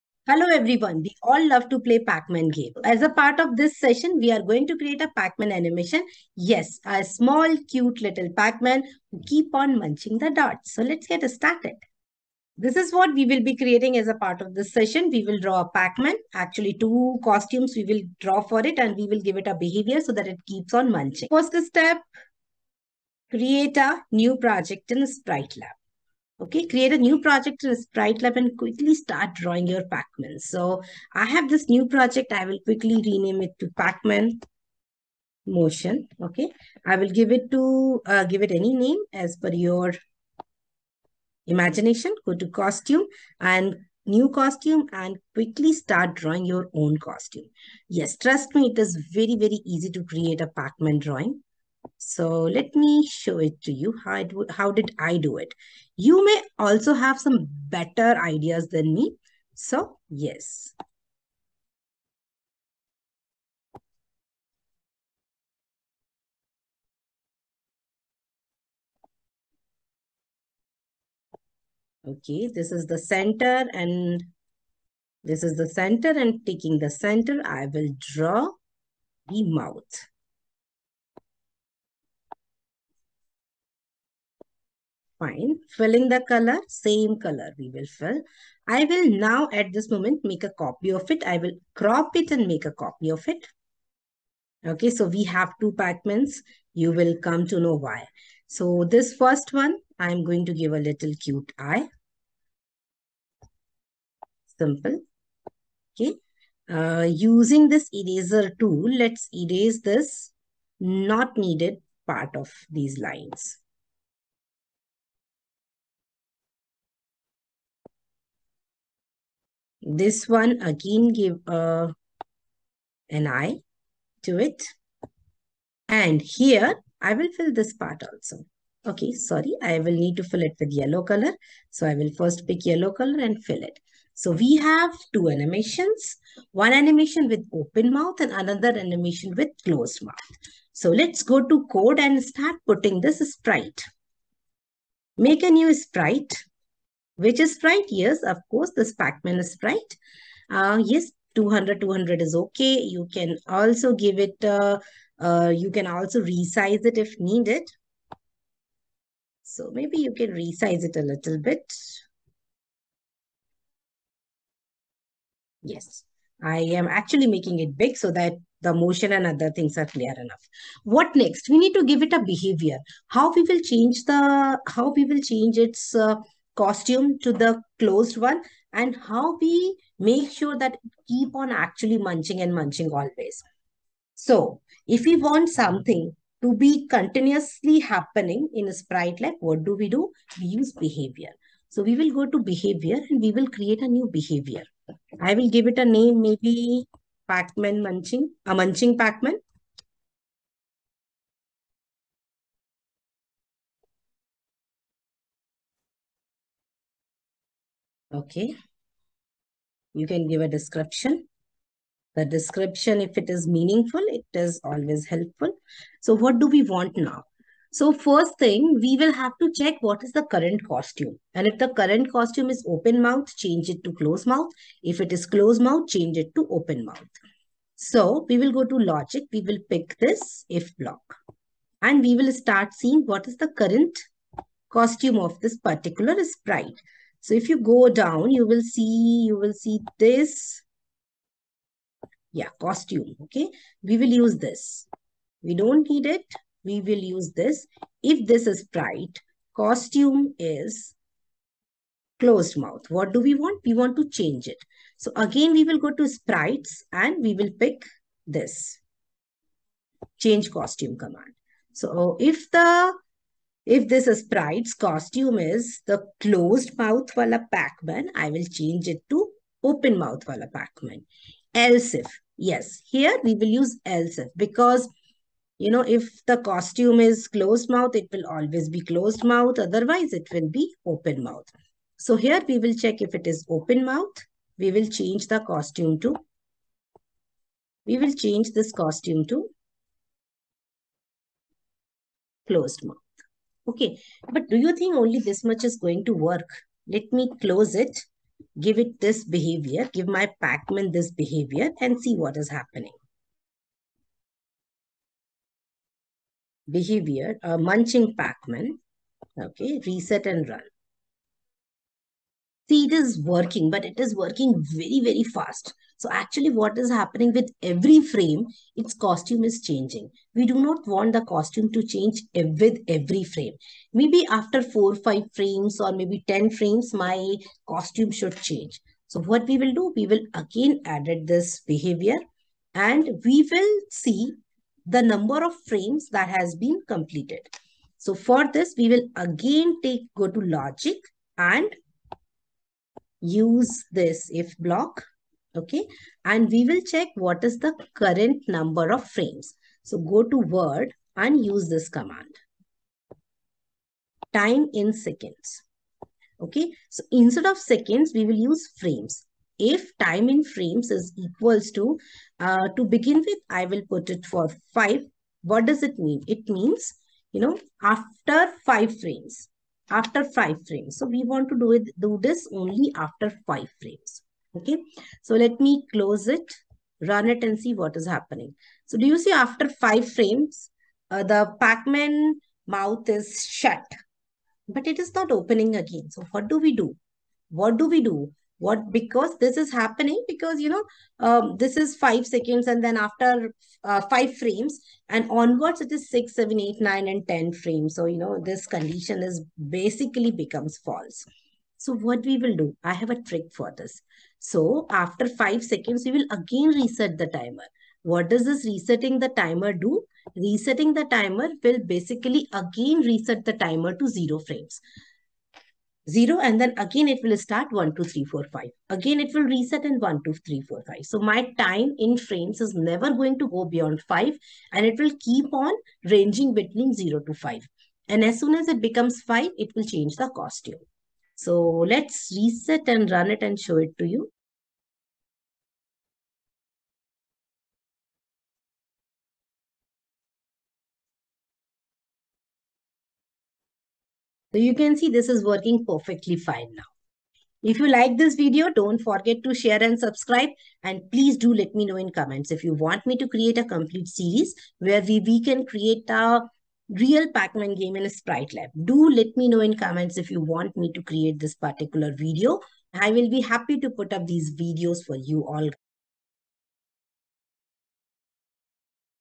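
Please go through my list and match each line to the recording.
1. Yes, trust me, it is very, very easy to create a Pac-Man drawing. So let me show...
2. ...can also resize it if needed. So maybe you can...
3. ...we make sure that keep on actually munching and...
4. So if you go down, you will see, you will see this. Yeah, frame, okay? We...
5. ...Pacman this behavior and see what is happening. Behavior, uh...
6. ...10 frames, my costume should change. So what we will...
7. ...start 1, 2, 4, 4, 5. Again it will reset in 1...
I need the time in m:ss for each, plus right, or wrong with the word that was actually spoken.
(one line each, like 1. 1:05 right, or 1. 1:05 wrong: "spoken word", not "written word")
1. 0:47 right
2. 2:35 right
3. 2:59 right
4. 3:57 wrong: "costume", not "frame"
5. 5:00 right
6. 5:26 right
7. 6:57 wrong: "3", not "4".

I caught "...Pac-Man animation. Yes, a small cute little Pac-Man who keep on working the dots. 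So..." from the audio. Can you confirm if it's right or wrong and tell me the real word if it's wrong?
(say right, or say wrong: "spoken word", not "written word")
wrong: "munching", not "working".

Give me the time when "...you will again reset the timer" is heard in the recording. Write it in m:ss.
6:46.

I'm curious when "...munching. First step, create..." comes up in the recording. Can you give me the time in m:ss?
0:20.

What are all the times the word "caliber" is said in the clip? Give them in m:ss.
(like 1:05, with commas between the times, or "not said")
not said.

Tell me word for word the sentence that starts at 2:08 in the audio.
Okay, sorry, I will need to fill it with yellow color.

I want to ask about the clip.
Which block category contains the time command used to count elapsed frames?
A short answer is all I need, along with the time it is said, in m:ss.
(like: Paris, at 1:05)
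World, at 5:50.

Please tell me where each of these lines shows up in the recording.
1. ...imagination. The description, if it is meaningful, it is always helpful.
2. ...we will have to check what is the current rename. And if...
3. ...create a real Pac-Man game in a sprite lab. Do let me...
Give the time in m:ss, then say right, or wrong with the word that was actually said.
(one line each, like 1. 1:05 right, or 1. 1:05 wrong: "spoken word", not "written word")
1. 3:30 wrong: "description", not "imagination"
2. 3:38 wrong: "costume", not "rename"
3. 7:35 right.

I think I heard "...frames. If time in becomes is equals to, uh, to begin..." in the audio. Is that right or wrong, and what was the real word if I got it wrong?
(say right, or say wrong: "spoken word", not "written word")
wrong: "frames", not "becomes".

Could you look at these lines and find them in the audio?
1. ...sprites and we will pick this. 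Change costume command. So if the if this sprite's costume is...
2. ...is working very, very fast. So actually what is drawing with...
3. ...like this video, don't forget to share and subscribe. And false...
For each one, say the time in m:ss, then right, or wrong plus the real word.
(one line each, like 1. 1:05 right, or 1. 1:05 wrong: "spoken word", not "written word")
1. 4:16 right
2. 5:13 wrong: "happening", not "drawing"
3. 7:27 wrong: "please", not "false".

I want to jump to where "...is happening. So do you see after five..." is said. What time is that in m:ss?
6:17.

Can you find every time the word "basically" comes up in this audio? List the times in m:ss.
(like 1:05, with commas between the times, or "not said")
6:39, 6:51.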